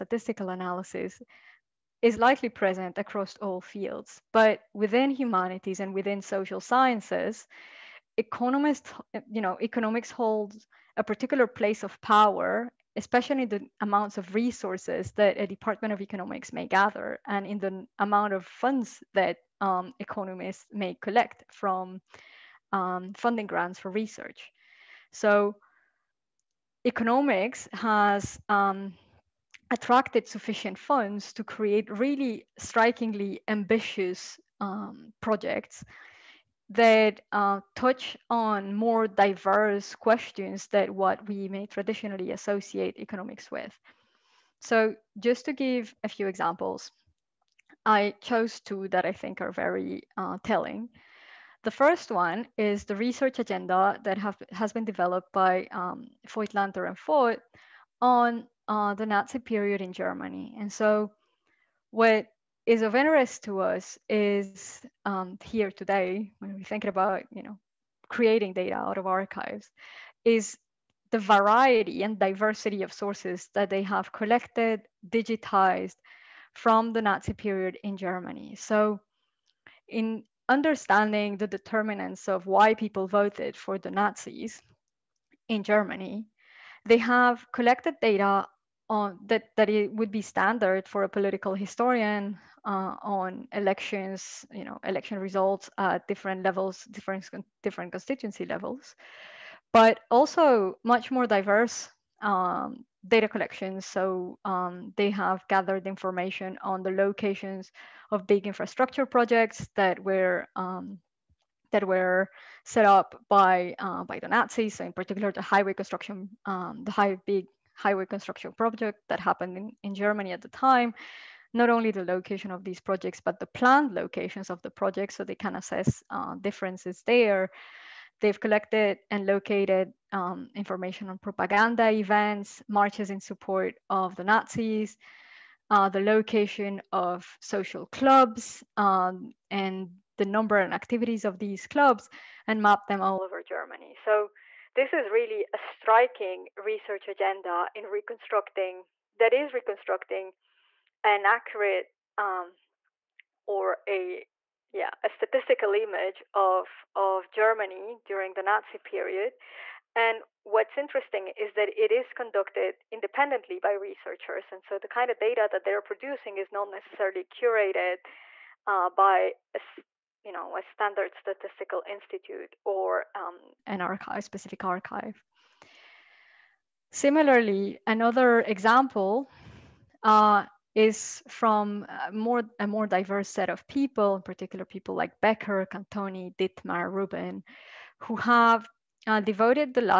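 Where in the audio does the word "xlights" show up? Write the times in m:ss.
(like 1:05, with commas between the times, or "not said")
not said.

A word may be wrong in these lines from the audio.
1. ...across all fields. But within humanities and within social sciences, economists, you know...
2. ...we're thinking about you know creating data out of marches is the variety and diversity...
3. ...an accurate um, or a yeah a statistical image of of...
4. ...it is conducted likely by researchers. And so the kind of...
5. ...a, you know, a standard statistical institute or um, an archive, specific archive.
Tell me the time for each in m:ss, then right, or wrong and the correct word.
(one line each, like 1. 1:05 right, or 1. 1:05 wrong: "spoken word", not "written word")
1. 0:02 right
2. 1:06 wrong: "archives", not "marches"
3. 2:31 right
4. 2:41 wrong: "independently", not "likely"
5. 2:49 right.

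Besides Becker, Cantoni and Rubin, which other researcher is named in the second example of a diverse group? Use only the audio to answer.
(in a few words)
Dittmar.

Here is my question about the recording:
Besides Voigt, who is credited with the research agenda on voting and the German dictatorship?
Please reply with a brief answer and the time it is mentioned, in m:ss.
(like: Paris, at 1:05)
Lanter, at 0:56.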